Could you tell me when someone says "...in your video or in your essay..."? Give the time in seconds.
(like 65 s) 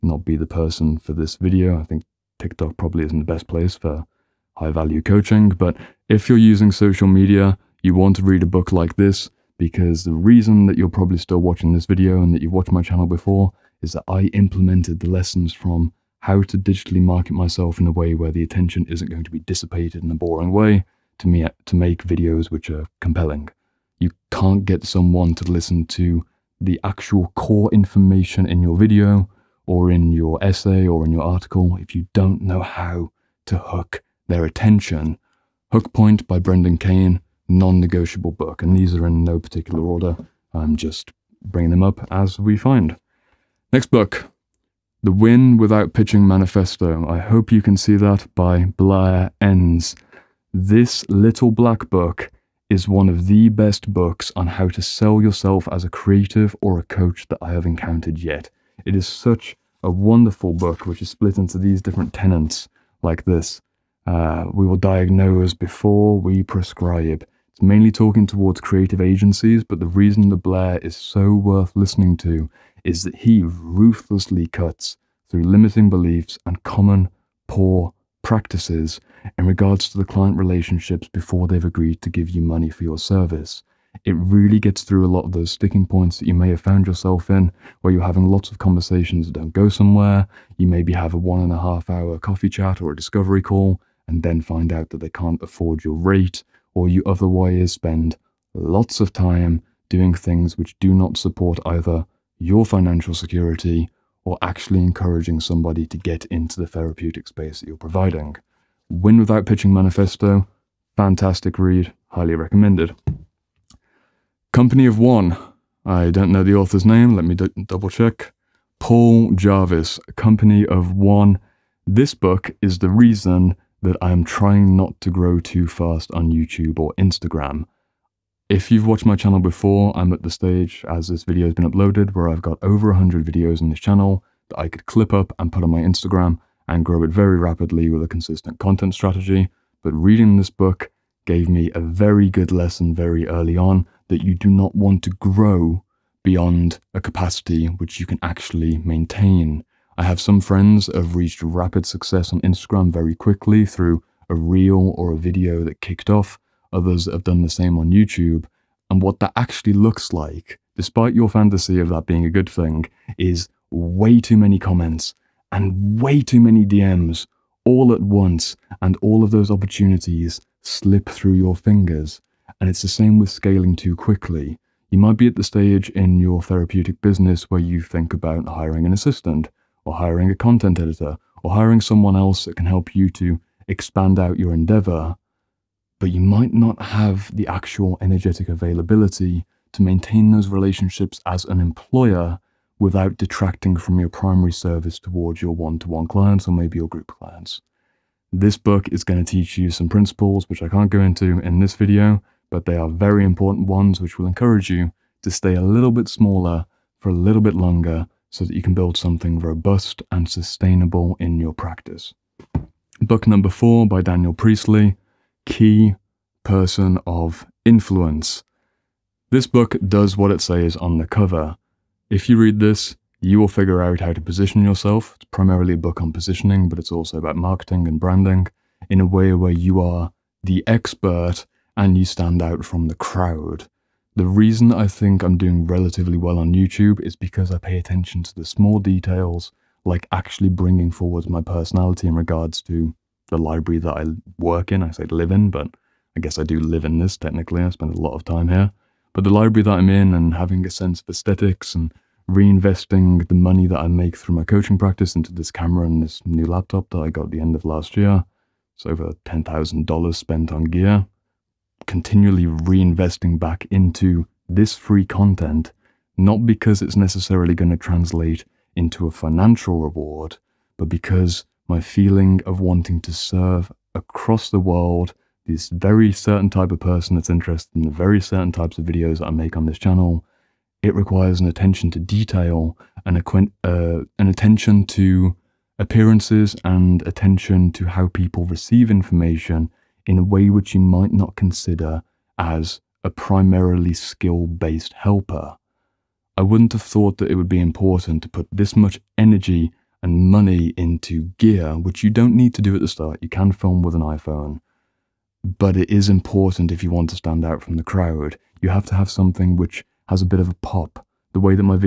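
28 s.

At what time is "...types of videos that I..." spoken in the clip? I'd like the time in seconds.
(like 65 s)
278 s.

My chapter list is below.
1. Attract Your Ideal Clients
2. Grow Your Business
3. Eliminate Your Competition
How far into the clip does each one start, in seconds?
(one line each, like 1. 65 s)
1. 42 s
2. 112 s
3. 212 s.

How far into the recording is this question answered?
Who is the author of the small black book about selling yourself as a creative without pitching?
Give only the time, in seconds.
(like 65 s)
48 s.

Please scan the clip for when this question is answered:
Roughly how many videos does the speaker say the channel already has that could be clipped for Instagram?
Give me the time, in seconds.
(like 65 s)
132 s.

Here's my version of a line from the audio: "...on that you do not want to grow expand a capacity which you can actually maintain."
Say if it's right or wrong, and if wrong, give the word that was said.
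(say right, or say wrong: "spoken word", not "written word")
wrong: "beyond", not "expand".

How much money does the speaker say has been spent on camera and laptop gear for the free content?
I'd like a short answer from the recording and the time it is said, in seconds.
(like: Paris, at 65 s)
over $10,000, at 258 s.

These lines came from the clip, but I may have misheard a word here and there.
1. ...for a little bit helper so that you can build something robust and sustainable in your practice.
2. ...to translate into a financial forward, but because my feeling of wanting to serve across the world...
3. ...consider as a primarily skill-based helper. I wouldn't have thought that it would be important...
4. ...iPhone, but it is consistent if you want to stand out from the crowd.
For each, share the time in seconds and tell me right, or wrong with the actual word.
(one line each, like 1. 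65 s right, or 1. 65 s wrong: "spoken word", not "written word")
1. 206 s wrong: "longer", not "helper"
2. 267 s wrong: "reward", not "forward"
3. 291 s right
4. 303 s wrong: "important", not "consistent".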